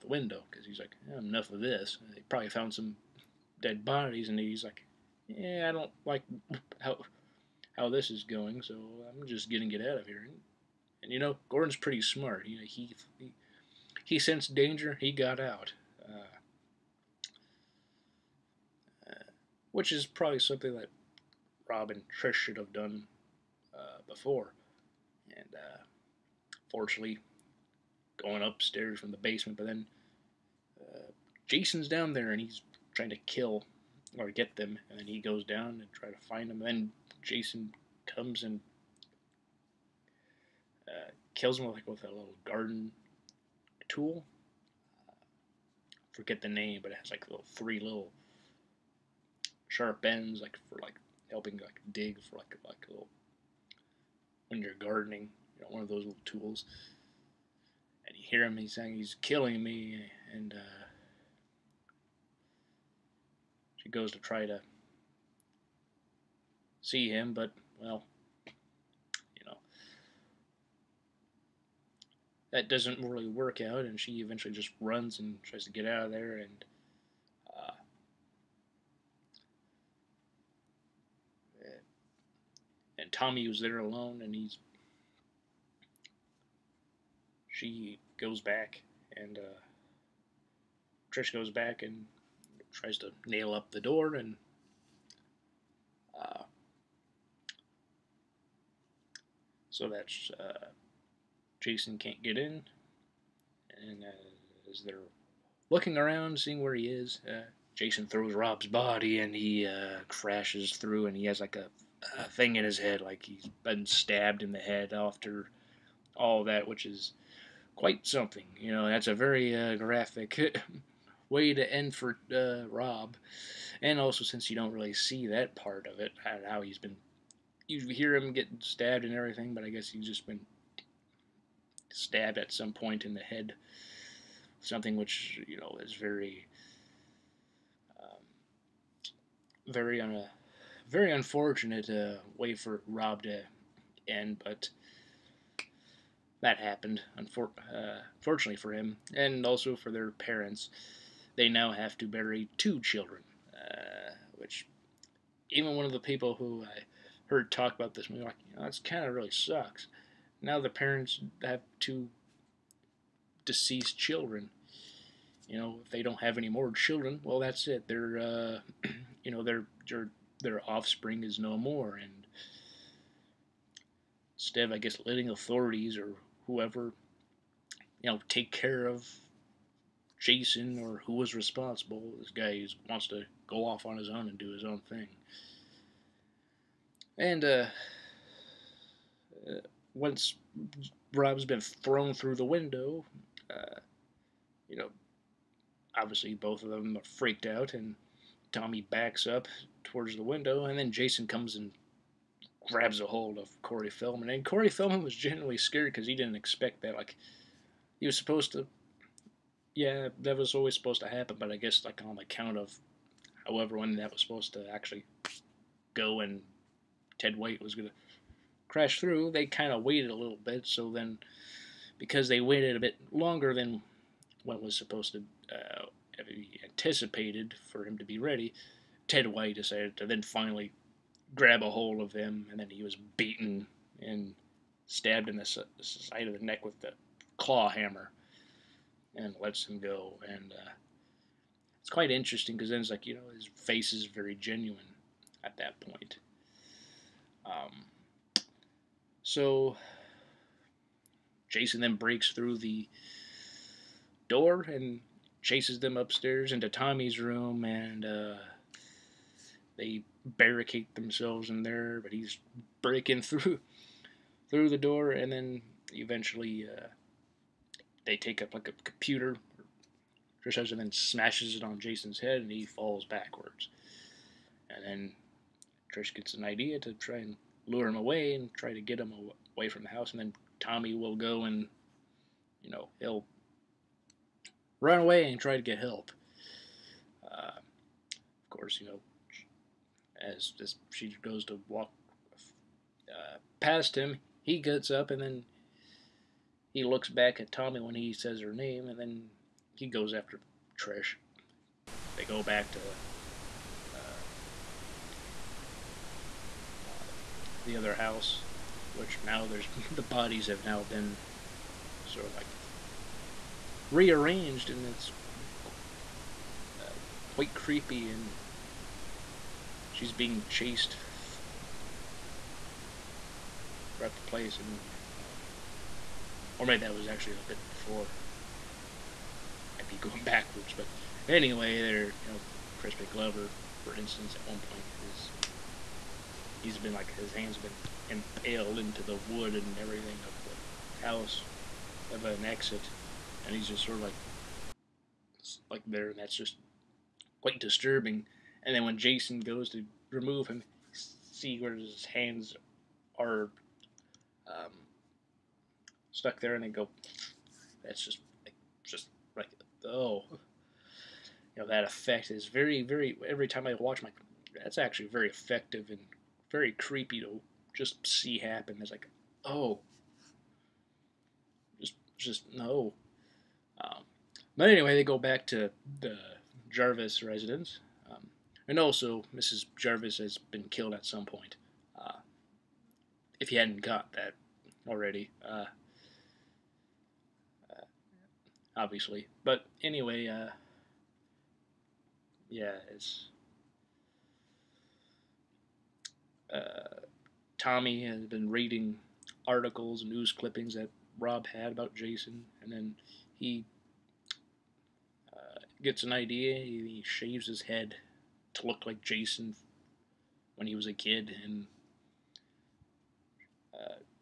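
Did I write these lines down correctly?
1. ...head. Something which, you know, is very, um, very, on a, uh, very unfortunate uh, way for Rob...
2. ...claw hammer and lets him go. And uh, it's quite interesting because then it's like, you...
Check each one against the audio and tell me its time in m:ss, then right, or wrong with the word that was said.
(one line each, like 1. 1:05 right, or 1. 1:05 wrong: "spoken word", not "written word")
1. 2:13 right
2. 3:57 right.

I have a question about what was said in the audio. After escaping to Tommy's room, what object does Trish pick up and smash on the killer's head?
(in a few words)
a computer.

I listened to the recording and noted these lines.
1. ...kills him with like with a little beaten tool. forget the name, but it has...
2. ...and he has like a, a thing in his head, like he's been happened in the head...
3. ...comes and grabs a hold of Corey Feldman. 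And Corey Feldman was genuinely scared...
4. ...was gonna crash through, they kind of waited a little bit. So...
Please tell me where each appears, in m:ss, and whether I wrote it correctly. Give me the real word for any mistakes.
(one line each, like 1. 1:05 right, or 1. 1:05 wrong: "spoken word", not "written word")
1. 0:41 wrong: "garden", not "beaten"
2. 1:51 wrong: "stabbed", not "happened"
3. 3:21 right
4. 3:37 right.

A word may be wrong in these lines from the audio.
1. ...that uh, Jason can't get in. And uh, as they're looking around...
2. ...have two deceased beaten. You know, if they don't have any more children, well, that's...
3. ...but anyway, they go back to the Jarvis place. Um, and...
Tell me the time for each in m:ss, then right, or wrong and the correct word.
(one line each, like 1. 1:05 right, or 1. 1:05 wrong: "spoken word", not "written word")
1. 1:39 right
2. 2:41 wrong: "children", not "beaten"
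3. 6:14 wrong: "residence", not "place".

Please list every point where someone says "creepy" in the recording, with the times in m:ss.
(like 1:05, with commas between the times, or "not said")
5:17, 6:06.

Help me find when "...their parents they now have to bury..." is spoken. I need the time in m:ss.
2:29.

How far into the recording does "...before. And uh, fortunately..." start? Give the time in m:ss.
0:24.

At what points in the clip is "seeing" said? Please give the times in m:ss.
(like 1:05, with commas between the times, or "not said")
1:46.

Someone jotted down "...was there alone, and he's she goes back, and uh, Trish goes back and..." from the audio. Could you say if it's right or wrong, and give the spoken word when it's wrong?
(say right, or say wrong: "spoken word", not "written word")
right.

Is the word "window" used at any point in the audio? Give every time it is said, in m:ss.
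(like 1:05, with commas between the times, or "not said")
0:00, 3:12, 3:20.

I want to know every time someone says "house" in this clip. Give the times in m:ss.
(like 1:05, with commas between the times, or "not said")
4:39, 5:07, 5:41.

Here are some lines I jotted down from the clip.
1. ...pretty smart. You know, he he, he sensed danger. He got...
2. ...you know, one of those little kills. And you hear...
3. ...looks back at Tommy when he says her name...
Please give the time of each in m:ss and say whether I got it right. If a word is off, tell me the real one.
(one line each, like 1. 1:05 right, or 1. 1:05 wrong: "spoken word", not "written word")
1. 0:11 right
2. 0:55 wrong: "tools", not "kills"
3. 4:56 right.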